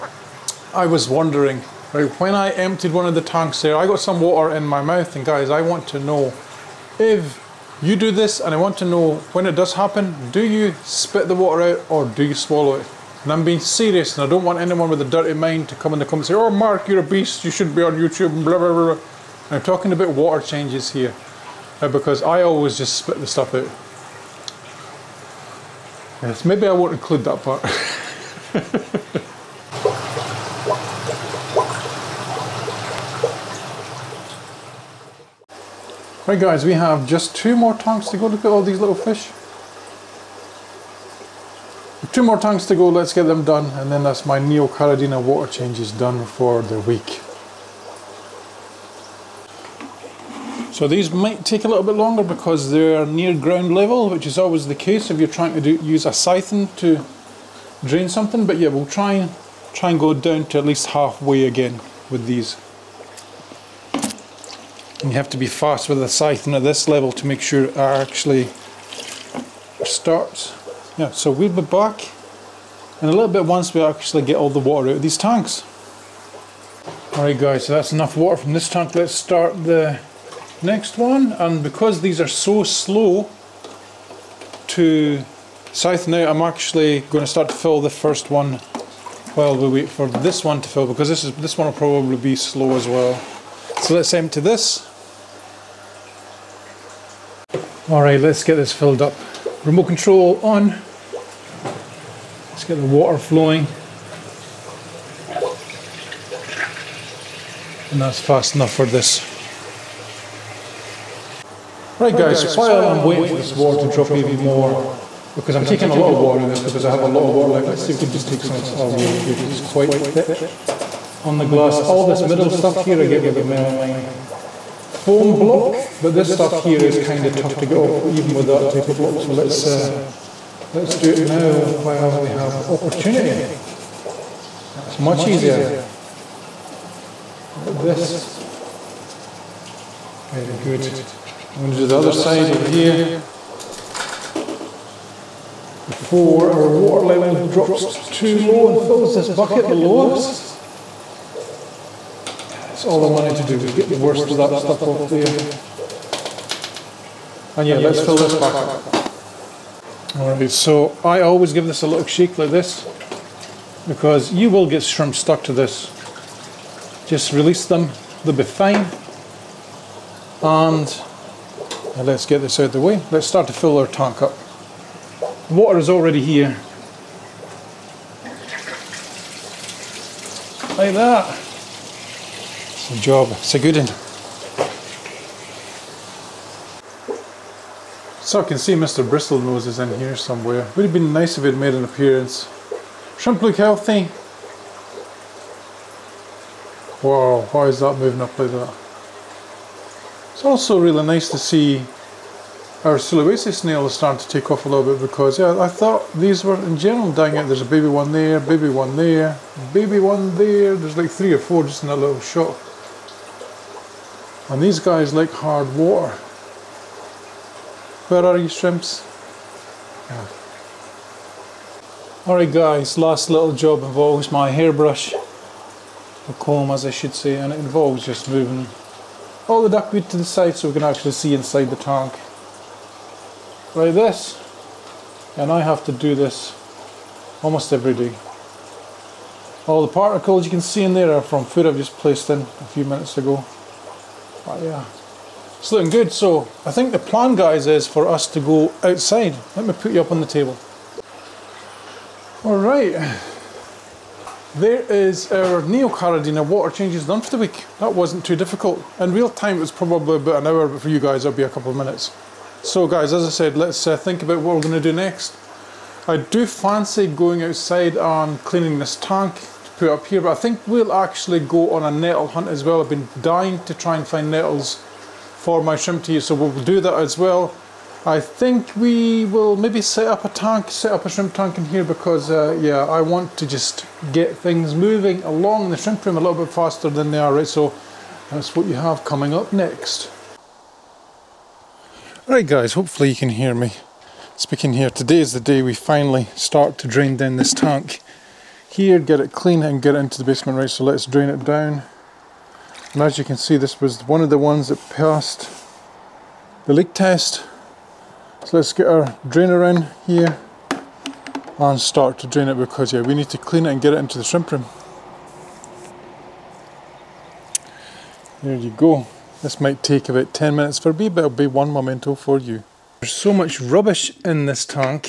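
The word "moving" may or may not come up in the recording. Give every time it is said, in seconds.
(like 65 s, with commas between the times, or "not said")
197 s, 228 s, 284 s.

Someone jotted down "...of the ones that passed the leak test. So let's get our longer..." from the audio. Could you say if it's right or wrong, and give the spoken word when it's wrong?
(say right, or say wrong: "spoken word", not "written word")
wrong: "drainer", not "longer".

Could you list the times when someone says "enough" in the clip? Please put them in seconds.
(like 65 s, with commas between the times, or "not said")
77 s, 108 s.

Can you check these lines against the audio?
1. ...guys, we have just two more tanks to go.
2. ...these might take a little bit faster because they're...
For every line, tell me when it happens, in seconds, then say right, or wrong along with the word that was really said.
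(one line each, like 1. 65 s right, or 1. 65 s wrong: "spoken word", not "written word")
1. 36 s right
2. 50 s wrong: "longer", not "faster".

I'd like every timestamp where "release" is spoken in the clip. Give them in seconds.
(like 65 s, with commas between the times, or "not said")
167 s.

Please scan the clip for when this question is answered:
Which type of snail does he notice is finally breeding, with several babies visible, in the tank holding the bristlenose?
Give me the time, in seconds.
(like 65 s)
202 s.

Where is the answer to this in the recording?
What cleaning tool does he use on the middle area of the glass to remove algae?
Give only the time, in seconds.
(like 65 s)
123 s.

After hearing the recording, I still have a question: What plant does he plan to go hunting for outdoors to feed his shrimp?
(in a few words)
nettles.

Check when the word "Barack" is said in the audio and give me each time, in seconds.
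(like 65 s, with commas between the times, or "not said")
not said.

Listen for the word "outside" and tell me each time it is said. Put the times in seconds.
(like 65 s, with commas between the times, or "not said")
248 s, 267 s.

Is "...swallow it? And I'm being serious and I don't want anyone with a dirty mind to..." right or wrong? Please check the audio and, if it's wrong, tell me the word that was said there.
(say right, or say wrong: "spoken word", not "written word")
right.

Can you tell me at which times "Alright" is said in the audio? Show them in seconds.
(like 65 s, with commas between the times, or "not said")
77 s, 160 s, 222 s.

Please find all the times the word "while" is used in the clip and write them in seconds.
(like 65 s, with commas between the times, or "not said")
89 s, 112 s, 131 s.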